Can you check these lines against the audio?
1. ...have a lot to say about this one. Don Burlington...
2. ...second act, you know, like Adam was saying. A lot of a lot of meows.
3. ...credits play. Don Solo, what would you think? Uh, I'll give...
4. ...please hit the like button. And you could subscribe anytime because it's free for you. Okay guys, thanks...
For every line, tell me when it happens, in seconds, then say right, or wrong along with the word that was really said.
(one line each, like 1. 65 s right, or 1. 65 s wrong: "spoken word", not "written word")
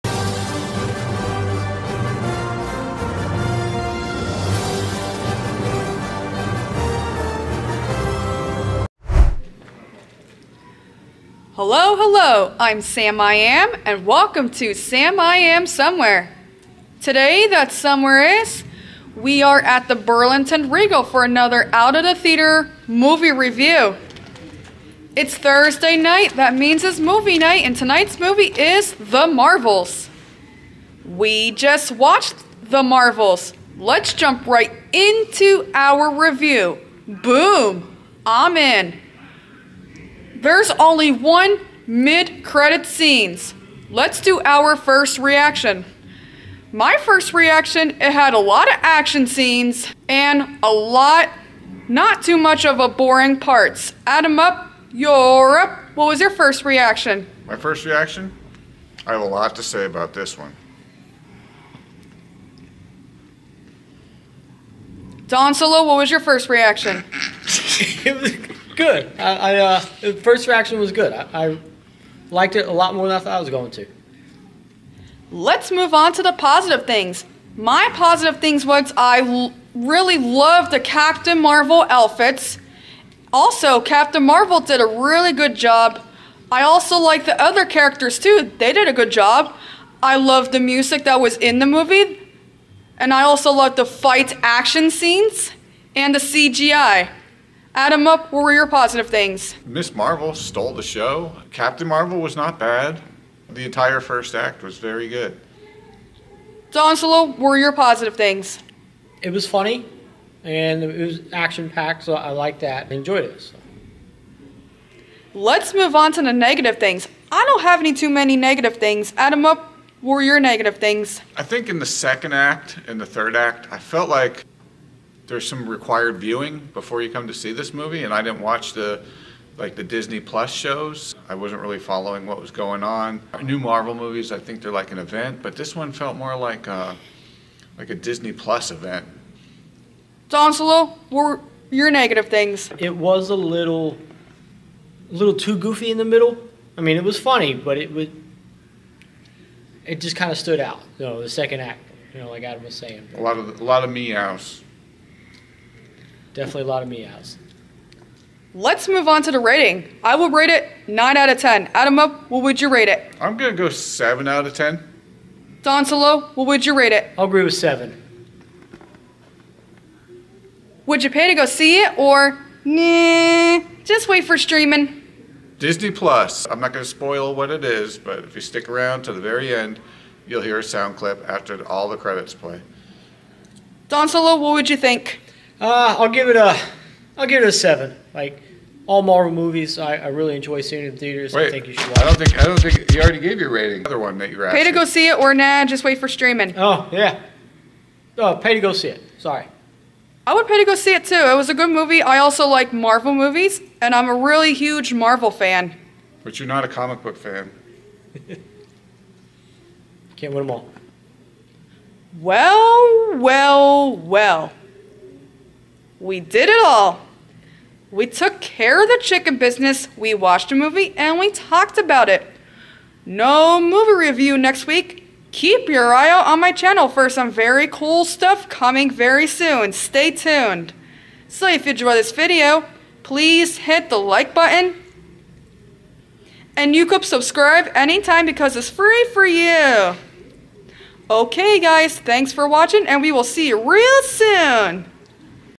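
1. 59 s wrong: "Solo", not "Burlington"
2. 151 s right
3. 181 s right
4. 233 s right.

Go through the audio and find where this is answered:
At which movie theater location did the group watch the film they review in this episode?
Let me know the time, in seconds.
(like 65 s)
19 s.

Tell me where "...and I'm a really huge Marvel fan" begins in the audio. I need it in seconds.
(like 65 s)
203 s.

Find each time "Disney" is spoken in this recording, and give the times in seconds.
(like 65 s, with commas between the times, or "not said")
129 s, 137 s, 175 s.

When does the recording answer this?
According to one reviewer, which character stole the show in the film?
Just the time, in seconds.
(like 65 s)
99 s.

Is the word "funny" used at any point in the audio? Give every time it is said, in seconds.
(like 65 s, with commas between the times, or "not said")
109 s, 147 s.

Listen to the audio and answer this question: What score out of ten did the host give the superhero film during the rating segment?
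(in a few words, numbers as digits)
9 out of 10.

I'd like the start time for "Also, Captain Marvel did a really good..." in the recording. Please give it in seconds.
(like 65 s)
83 s.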